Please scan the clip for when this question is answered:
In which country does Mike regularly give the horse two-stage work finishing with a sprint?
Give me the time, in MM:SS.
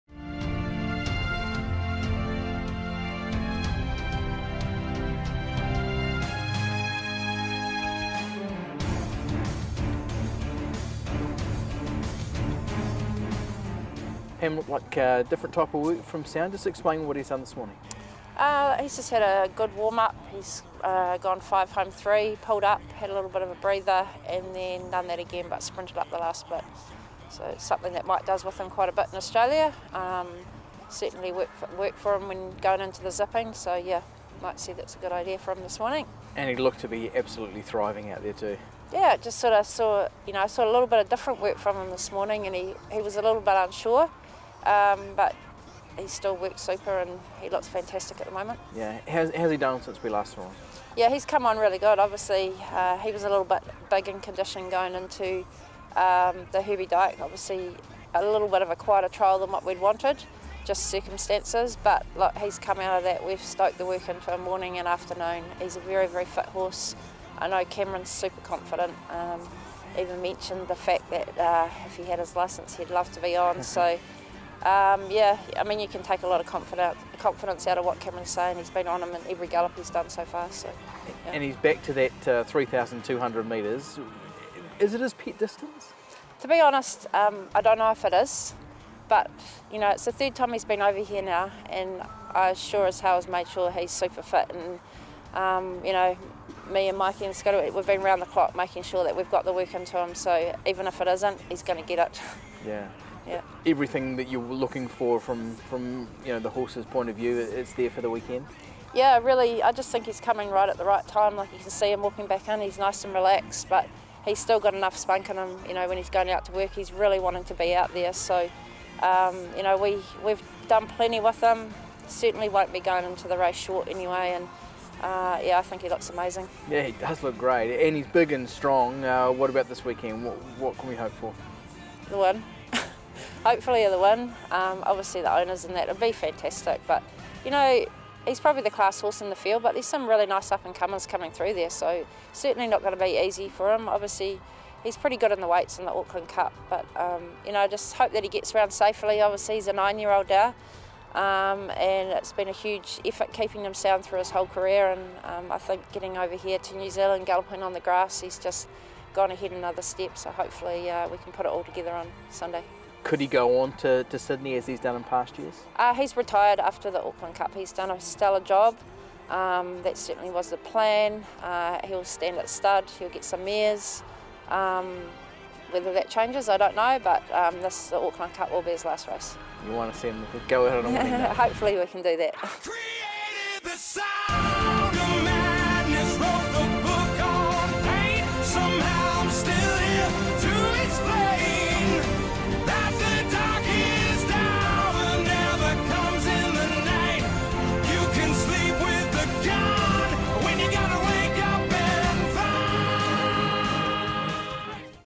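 00:29.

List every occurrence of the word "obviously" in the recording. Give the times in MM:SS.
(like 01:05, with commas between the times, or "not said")
00:51, 00:57, 02:14, 02:23, 02:29.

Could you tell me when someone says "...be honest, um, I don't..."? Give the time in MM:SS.
01:26.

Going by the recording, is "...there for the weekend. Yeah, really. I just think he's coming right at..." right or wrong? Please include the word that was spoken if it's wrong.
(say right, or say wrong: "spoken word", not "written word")
right.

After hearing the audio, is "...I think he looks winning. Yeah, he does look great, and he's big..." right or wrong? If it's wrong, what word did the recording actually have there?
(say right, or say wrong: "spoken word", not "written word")
wrong: "amazing", not "winning".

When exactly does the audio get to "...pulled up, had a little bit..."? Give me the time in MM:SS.
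00:22.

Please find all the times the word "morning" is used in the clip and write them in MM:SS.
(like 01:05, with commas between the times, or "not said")
00:17, 00:35, 00:42, 01:04.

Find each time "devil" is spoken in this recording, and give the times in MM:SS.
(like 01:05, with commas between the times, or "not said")
not said.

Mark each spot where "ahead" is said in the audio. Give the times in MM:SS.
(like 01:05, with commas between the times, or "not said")
02:39, 03:00.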